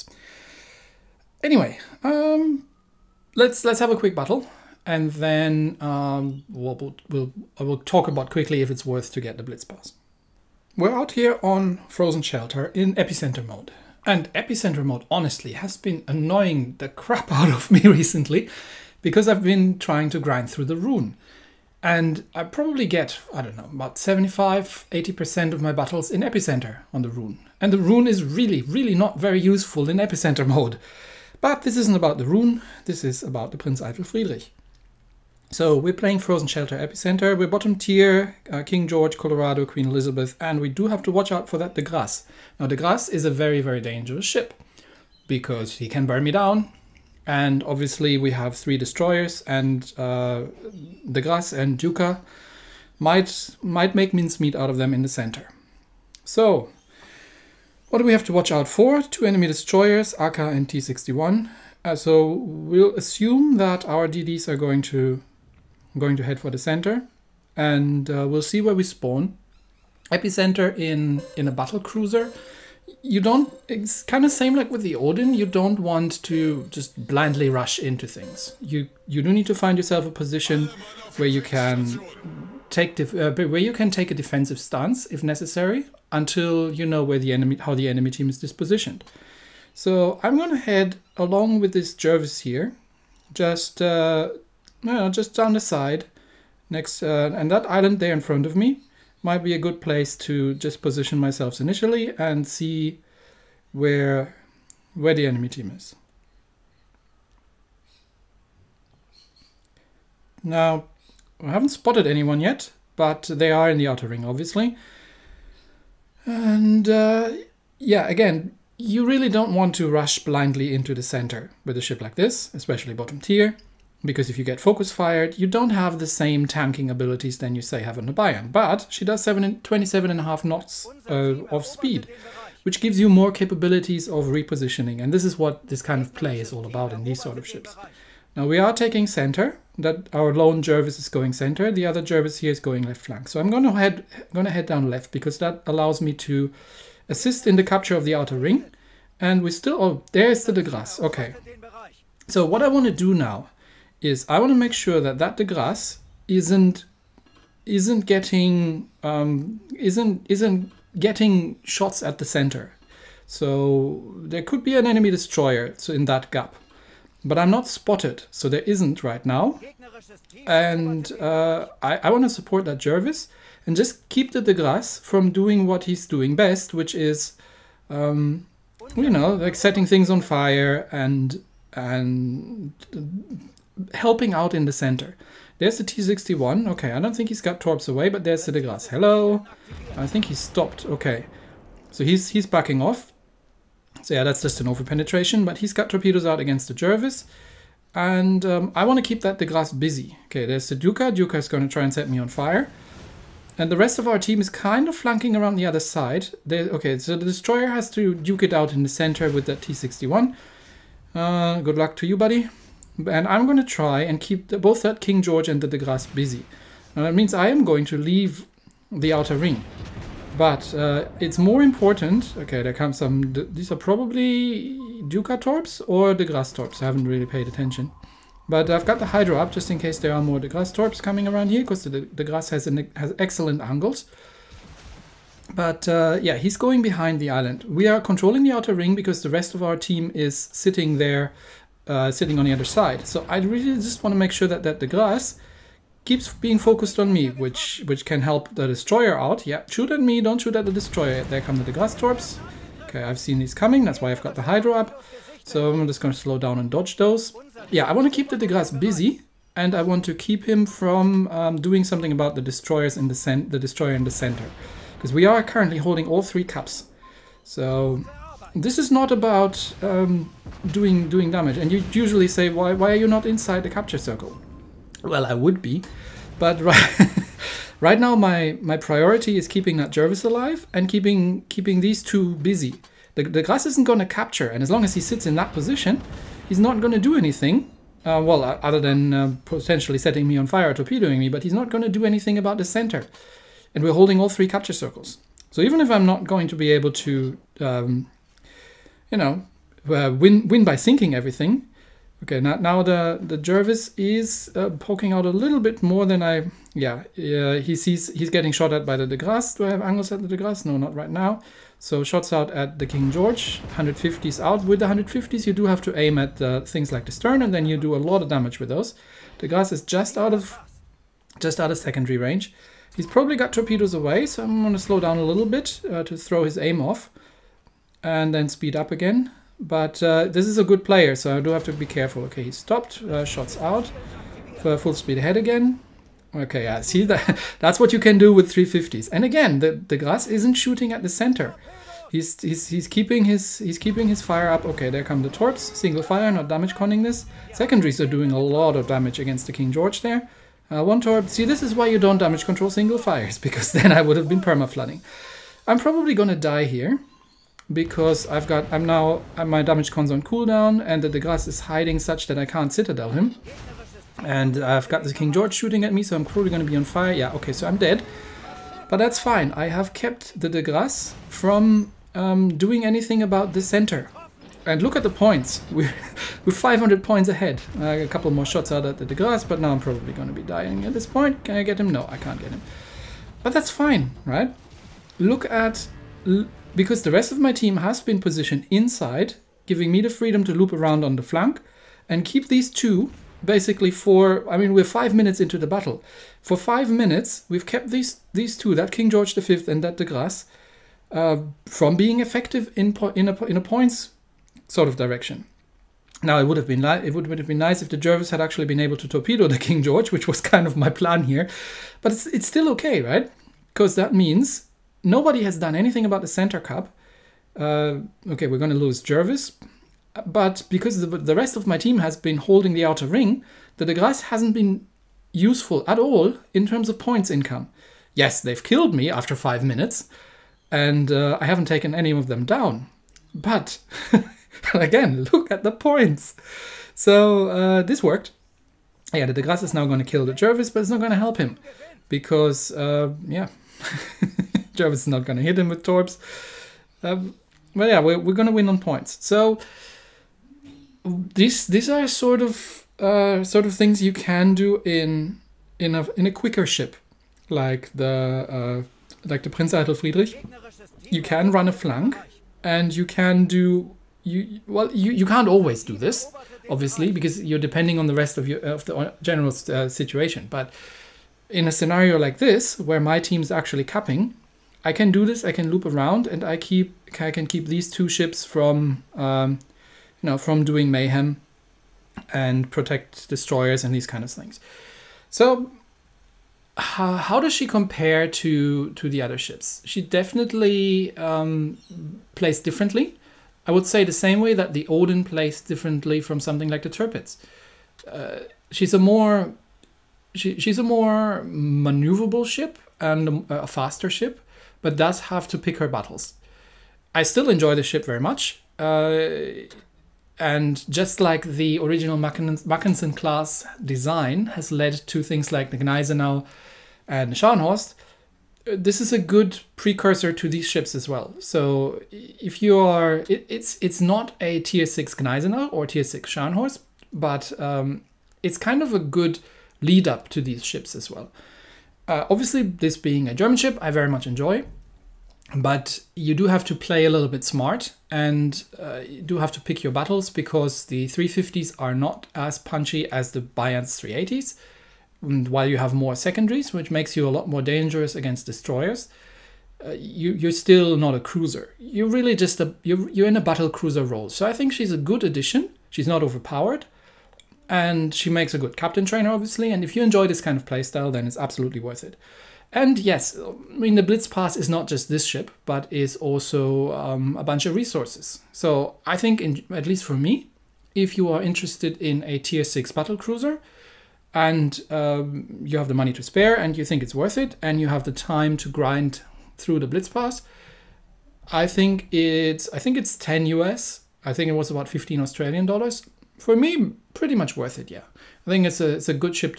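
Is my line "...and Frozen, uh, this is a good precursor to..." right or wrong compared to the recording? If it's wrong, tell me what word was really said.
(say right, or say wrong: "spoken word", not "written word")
wrong: "Scharnhorst", not "Frozen".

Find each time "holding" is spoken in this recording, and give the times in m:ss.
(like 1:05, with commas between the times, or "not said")
4:25, 4:53, 7:02.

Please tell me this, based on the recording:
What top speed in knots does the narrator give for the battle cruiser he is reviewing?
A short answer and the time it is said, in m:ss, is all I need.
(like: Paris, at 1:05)
27.5 knots, at 2:09.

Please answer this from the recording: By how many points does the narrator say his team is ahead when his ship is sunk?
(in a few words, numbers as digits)
500.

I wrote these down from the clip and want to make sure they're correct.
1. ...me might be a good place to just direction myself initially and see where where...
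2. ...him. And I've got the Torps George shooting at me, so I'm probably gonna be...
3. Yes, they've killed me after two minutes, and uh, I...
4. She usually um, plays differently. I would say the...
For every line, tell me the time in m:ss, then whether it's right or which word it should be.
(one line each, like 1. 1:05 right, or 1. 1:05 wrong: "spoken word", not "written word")
1. 1:38 wrong: "position", not "direction"
2. 6:03 wrong: "King", not "Torps"
3. 7:08 wrong: "five", not "two"
4. 8:09 wrong: "definitely", not "usually".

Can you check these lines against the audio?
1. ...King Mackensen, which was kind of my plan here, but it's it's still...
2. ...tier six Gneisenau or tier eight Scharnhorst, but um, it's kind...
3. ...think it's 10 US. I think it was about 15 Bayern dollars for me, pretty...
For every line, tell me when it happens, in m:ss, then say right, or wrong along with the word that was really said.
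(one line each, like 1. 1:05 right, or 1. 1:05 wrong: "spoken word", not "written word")
1. 6:49 wrong: "George", not "Mackensen"
2. 8:44 wrong: "six", not "eight"
3. 9:42 wrong: "Australian", not "Bayern".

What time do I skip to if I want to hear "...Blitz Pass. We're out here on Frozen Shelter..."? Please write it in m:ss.
0:09.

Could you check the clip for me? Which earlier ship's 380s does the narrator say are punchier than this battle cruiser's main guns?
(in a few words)
Bayern.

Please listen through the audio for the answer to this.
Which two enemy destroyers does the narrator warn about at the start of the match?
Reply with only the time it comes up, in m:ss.
1:00.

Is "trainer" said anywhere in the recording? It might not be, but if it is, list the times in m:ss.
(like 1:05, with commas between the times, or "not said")
9:19.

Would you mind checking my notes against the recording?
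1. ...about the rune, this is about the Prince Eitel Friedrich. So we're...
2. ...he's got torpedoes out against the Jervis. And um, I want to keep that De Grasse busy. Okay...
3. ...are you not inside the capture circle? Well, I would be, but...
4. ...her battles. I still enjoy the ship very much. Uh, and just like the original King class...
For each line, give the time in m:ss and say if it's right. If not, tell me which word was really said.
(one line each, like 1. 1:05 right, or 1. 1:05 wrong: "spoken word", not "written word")
1. 0:31 right
2. 3:15 right
3. 4:32 right
4. 8:25 wrong: "Mackensen", not "King".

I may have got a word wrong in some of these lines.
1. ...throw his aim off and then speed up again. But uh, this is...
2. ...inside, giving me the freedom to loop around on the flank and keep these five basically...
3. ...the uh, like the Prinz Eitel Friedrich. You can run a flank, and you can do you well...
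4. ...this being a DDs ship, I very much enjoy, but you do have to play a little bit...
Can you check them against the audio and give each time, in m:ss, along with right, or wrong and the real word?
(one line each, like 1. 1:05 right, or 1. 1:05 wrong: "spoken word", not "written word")
1. 5:26 right
2. 6:28 wrong: "two", not "five"
3. 7:37 right
4. 8:52 wrong: "German", not "DDs".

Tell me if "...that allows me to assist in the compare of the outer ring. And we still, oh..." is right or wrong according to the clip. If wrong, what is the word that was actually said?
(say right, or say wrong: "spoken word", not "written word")
wrong: "capture", not "compare".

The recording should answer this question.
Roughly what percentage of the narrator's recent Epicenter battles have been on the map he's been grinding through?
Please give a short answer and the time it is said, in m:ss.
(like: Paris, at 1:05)
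75-80%, at 0:23.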